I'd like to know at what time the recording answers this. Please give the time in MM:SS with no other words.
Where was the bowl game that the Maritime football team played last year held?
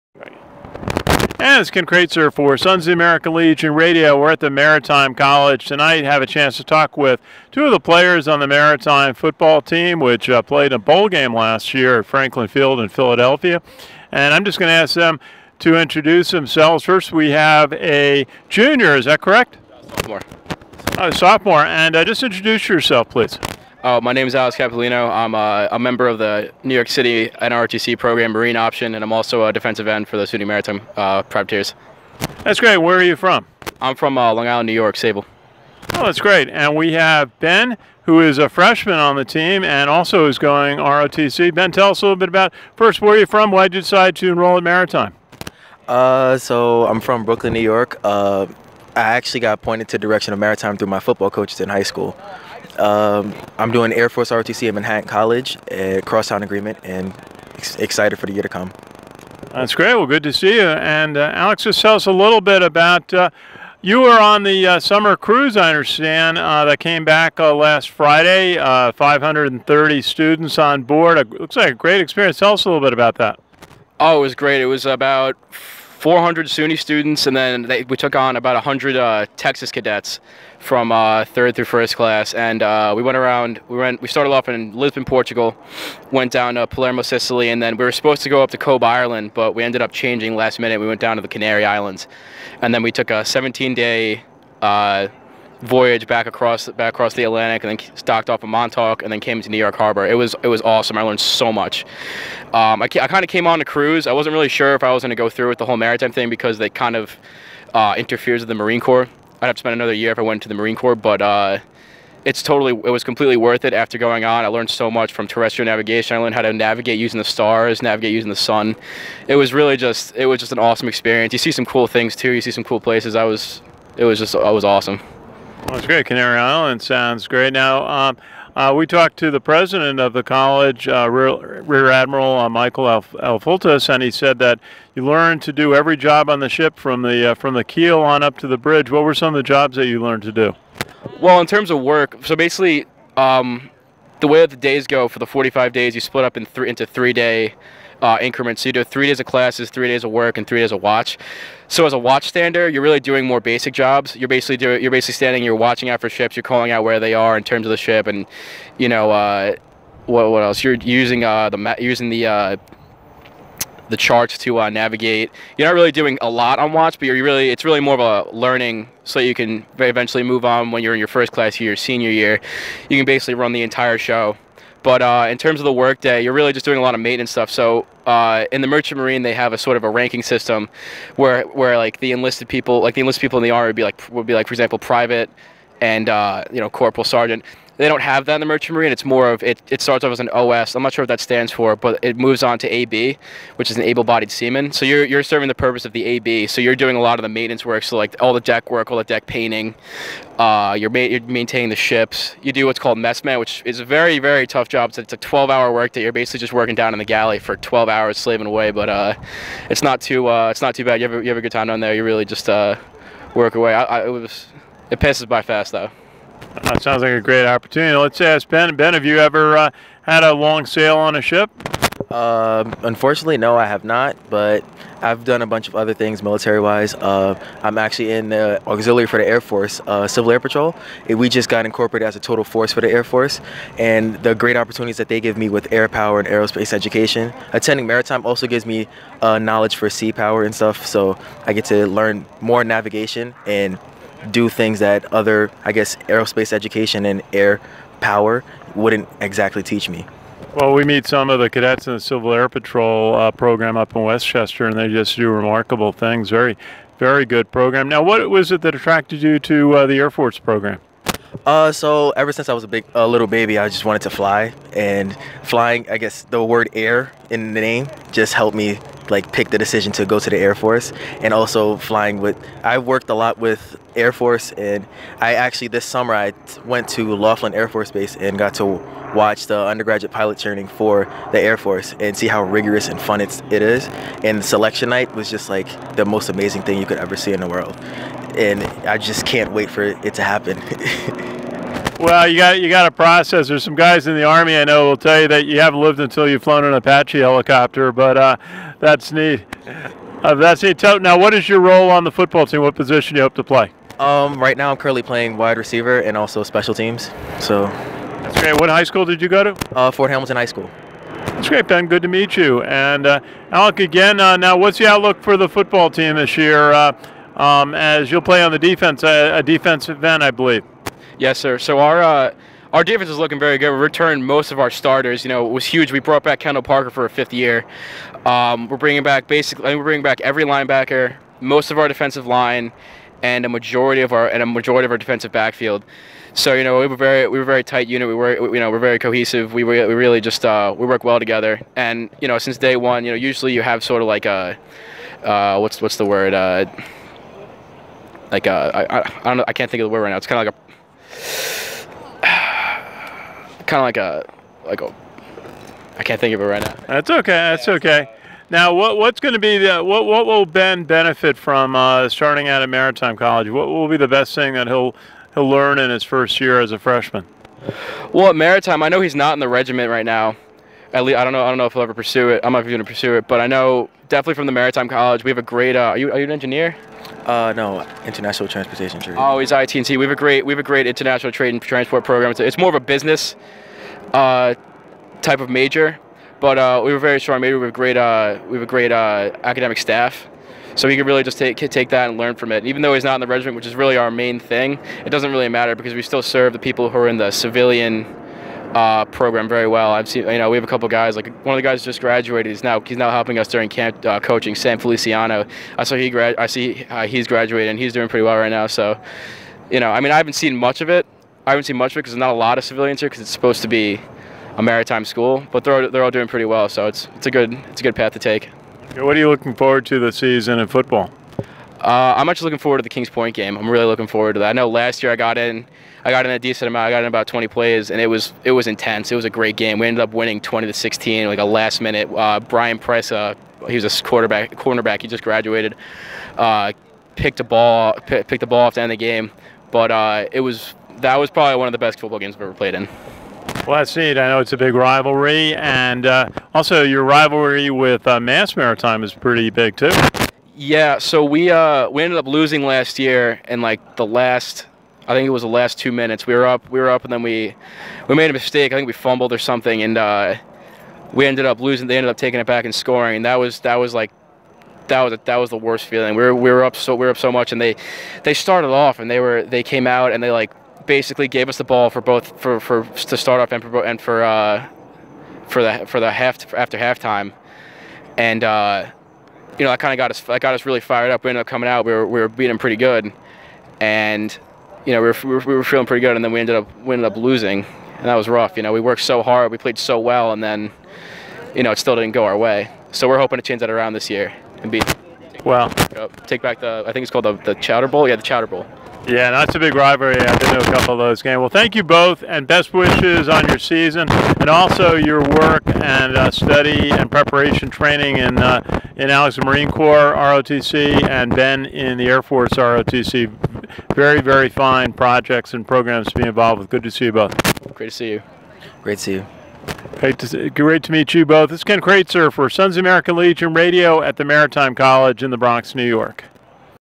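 00:12.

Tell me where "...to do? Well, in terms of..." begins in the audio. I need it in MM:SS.
02:20.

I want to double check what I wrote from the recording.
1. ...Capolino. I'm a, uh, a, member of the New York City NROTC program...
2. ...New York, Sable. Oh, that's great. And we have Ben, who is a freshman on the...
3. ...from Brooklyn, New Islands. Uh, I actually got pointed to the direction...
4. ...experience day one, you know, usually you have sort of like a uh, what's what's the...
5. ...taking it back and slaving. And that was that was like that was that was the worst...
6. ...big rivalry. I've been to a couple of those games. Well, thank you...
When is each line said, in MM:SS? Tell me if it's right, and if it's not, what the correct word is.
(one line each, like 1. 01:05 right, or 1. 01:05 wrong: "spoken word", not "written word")
1. 00:24 right
2. 00:34 right
3. 00:47 wrong: "York", not "Islands"
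4. 05:42 wrong: "since", not "experience"
5. 07:42 wrong: "scoring", not "slaving"
6. 08:19 right.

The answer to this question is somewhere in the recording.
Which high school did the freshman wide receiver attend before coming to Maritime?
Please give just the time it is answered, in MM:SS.
05:09.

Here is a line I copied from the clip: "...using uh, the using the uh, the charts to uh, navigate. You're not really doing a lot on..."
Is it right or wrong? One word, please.
right.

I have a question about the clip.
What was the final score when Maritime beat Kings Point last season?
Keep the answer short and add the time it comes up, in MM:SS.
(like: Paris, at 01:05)
20 to 16, at 07:10.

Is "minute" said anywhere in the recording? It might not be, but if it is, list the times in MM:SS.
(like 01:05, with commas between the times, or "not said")
01:30, 07:11, 07:35.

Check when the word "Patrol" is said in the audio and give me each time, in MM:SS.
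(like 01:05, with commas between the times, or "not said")
03:50, 04:12.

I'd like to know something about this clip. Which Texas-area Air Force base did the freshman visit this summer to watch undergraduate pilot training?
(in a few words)
Laughlin Air Force Base.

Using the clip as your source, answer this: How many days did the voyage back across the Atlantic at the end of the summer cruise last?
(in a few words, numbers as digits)
17.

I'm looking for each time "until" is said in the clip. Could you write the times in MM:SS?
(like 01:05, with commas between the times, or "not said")
04:55.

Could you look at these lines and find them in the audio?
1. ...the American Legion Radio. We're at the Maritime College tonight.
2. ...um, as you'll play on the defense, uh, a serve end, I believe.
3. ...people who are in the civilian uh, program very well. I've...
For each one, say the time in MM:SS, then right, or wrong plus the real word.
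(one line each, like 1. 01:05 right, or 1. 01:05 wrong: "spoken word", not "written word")
1. 00:02 right
2. 05:17 wrong: "defensive", not "serve"
3. 06:36 right.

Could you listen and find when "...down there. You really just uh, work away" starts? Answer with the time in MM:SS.
03:31.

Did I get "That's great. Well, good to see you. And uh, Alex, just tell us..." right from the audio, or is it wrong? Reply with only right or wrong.
right.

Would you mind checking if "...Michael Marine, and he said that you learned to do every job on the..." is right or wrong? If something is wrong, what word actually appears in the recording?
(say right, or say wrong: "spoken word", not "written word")
wrong: "Alfultis", not "Marine".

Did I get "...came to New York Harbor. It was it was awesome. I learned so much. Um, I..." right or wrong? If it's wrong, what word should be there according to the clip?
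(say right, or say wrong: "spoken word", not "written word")
right.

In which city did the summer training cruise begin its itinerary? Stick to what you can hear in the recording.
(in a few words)
Lisbon, Portugal.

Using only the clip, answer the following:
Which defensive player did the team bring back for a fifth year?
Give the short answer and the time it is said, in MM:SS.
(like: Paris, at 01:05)
Kendall Parker, at 05:26.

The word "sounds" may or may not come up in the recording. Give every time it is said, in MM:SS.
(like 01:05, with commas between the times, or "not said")
02:06, 03:36.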